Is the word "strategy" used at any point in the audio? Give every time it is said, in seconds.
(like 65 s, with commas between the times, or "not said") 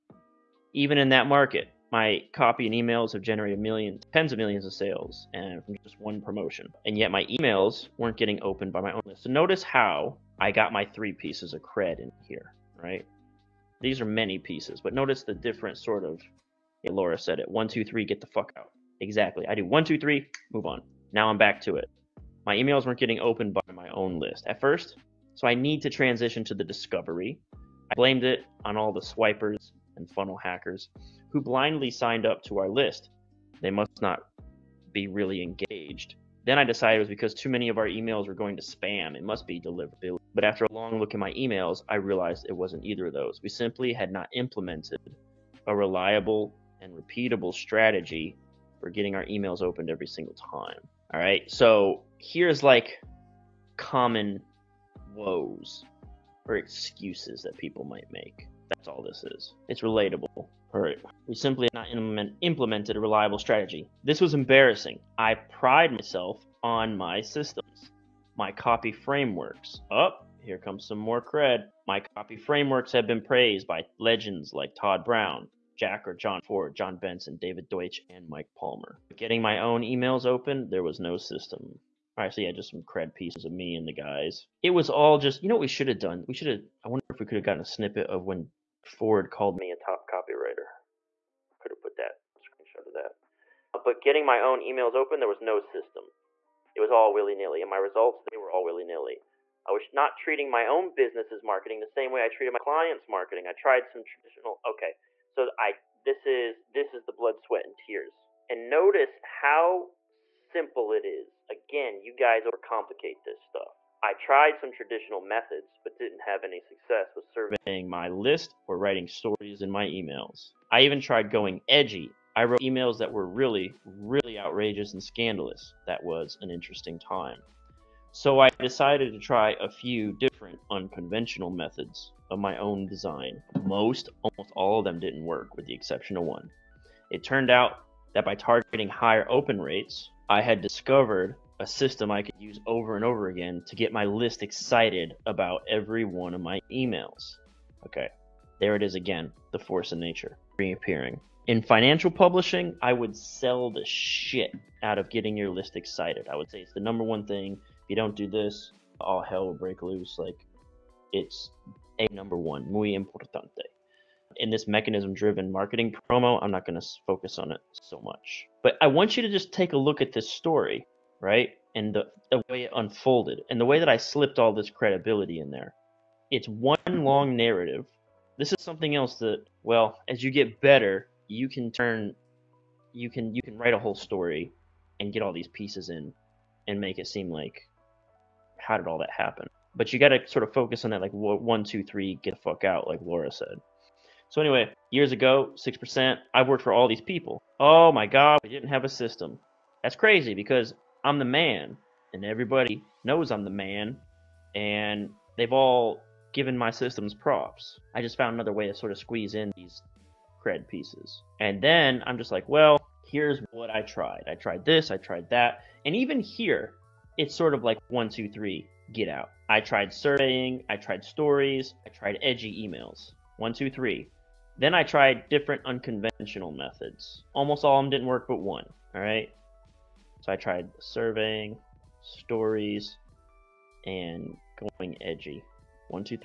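47 s, 63 s.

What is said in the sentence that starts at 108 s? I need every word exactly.
And notice how simple it is.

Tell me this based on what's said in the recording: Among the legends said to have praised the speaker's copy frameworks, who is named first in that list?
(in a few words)
Todd Brown.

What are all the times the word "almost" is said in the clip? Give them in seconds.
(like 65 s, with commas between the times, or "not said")
134 s, 227 s.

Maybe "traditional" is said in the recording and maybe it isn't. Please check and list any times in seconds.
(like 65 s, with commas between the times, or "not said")
104 s, 114 s.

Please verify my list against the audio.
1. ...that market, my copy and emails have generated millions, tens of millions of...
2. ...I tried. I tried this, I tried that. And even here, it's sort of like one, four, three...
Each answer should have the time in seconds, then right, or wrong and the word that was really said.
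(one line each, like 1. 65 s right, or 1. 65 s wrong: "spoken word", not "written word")
1. 1 s right
2. 213 s wrong: "two", not "four".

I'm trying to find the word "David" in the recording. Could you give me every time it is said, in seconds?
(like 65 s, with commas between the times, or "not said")
77 s.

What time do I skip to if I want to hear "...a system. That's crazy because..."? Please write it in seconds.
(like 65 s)
198 s.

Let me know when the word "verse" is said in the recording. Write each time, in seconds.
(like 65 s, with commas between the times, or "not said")
not said.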